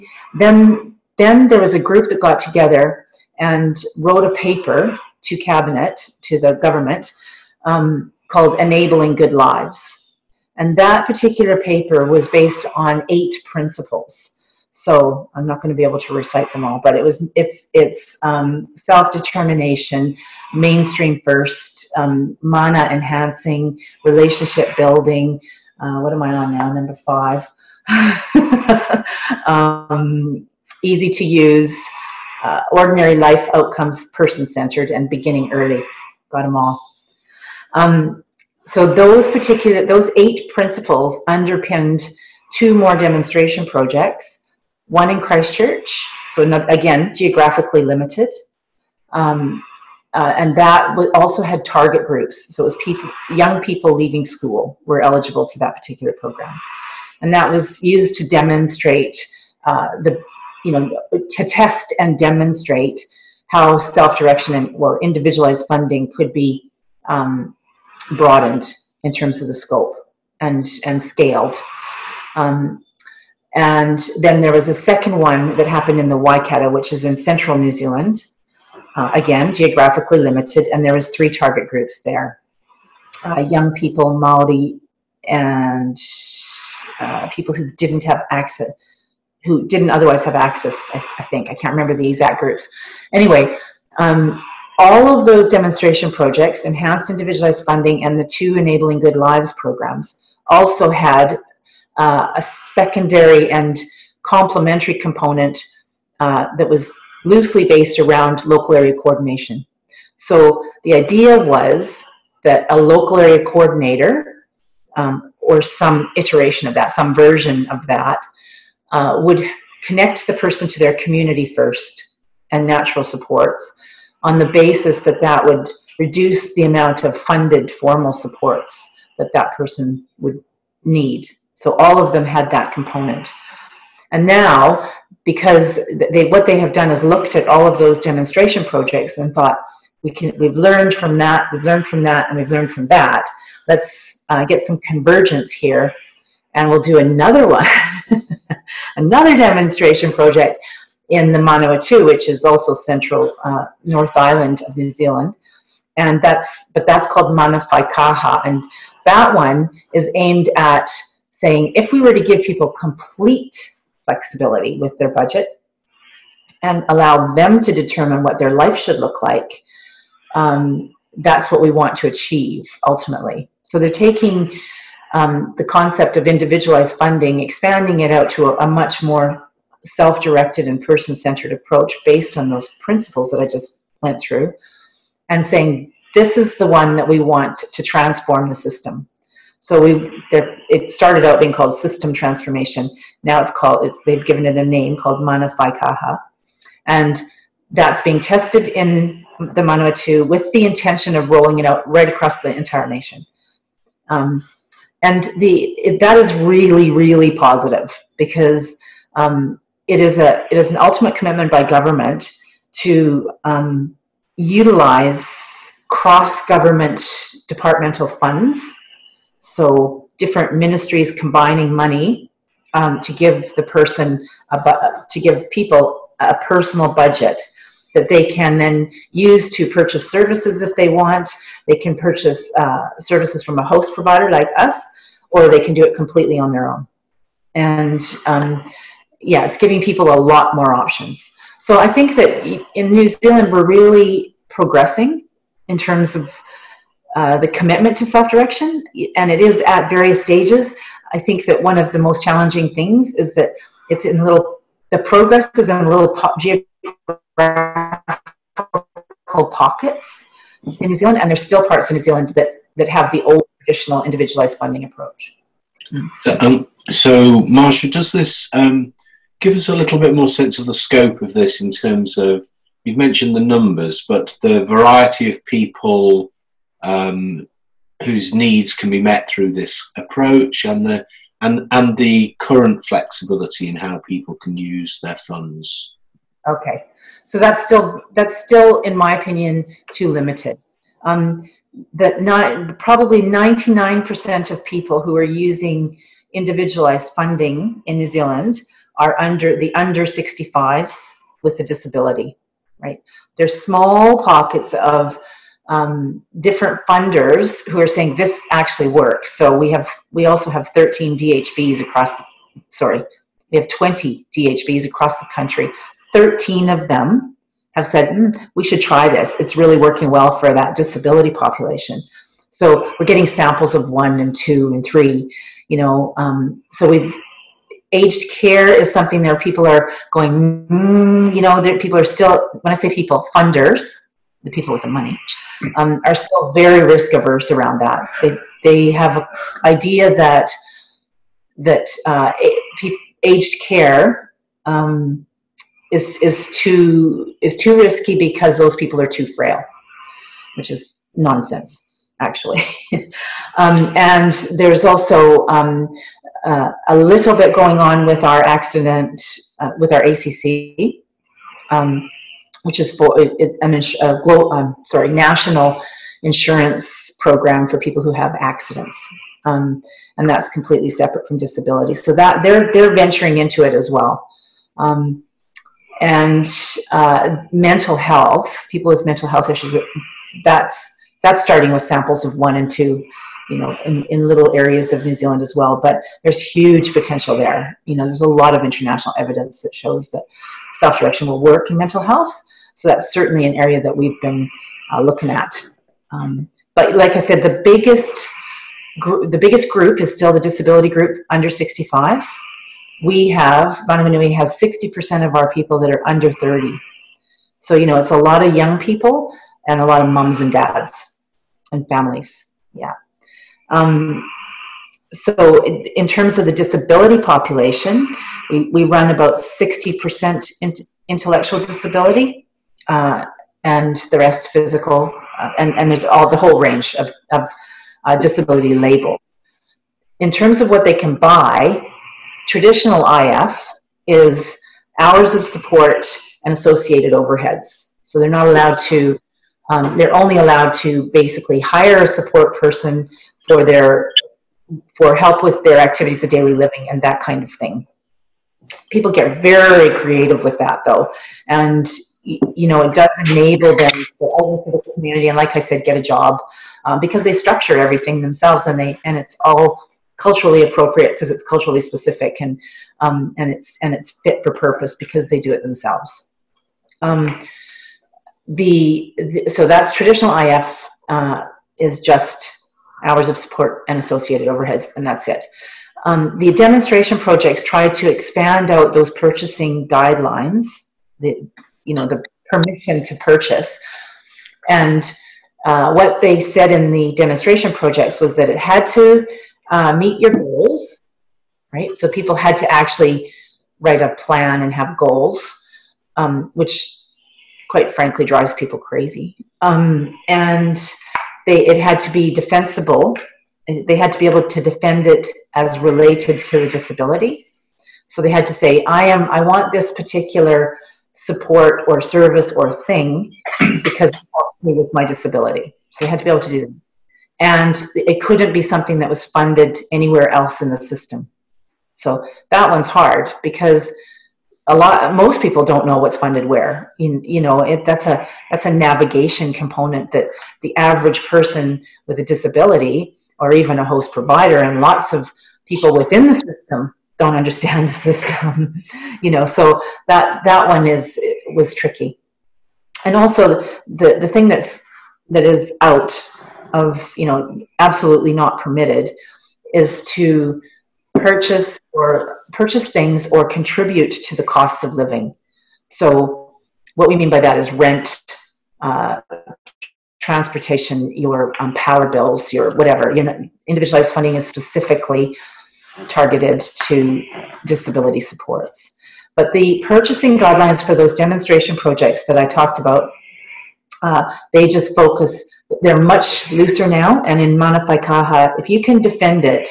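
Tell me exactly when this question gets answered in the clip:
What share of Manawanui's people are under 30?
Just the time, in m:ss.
6:44.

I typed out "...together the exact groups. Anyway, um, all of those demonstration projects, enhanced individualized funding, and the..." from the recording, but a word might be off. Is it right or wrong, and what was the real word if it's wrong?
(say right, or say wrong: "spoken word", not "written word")
wrong: "remember", not "together".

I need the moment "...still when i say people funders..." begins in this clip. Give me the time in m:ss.
5:32.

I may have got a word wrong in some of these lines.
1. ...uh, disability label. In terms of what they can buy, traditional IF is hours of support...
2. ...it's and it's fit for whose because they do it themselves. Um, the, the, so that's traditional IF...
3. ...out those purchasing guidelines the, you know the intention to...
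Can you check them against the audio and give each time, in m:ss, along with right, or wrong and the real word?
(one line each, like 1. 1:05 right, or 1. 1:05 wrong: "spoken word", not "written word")
1. 7:08 right
2. 7:43 wrong: "purpose", not "whose"
3. 7:58 wrong: "permission", not "intention".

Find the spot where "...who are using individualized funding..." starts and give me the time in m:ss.
4:55.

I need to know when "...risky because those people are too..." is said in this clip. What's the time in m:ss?
5:47.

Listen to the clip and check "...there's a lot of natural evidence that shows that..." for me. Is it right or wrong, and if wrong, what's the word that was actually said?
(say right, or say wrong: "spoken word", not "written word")
wrong: "international", not "natural".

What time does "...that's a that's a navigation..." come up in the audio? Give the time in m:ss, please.
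8:47.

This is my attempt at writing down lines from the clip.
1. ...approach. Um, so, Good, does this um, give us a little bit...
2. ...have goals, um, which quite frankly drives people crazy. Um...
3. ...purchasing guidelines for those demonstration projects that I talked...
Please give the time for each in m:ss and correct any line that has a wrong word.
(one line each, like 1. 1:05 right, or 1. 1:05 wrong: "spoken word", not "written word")
1. 4:24 wrong: "Marsha", not "Good"
2. 8:14 right
3. 9:29 right.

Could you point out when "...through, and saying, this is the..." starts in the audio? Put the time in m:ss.
3:04.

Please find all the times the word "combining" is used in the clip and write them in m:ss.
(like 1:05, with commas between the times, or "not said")
3:41.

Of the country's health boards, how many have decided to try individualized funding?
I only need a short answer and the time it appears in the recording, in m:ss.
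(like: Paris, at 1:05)
13, at 5:16.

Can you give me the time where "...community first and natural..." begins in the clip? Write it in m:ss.
2:00.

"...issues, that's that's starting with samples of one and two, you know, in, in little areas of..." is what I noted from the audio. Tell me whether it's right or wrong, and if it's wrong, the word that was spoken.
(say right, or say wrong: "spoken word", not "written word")
right.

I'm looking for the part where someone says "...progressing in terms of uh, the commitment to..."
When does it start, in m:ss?
4:04.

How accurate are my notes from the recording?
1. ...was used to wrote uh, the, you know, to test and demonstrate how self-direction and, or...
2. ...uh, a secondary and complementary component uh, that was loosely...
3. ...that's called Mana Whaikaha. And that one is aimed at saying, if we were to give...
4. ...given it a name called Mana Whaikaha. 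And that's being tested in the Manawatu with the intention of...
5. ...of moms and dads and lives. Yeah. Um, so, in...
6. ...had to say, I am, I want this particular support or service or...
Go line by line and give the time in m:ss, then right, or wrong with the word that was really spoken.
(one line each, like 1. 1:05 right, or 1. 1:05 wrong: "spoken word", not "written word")
1. 0:57 wrong: "demonstrate", not "wrote"
2. 1:41 right
3. 2:36 right
4. 3:14 right
5. 6:50 wrong: "families", not "lives"
6. 8:28 right.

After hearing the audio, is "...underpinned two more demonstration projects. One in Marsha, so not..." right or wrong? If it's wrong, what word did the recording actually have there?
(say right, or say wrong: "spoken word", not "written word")
wrong: "Christchurch", not "Marsha".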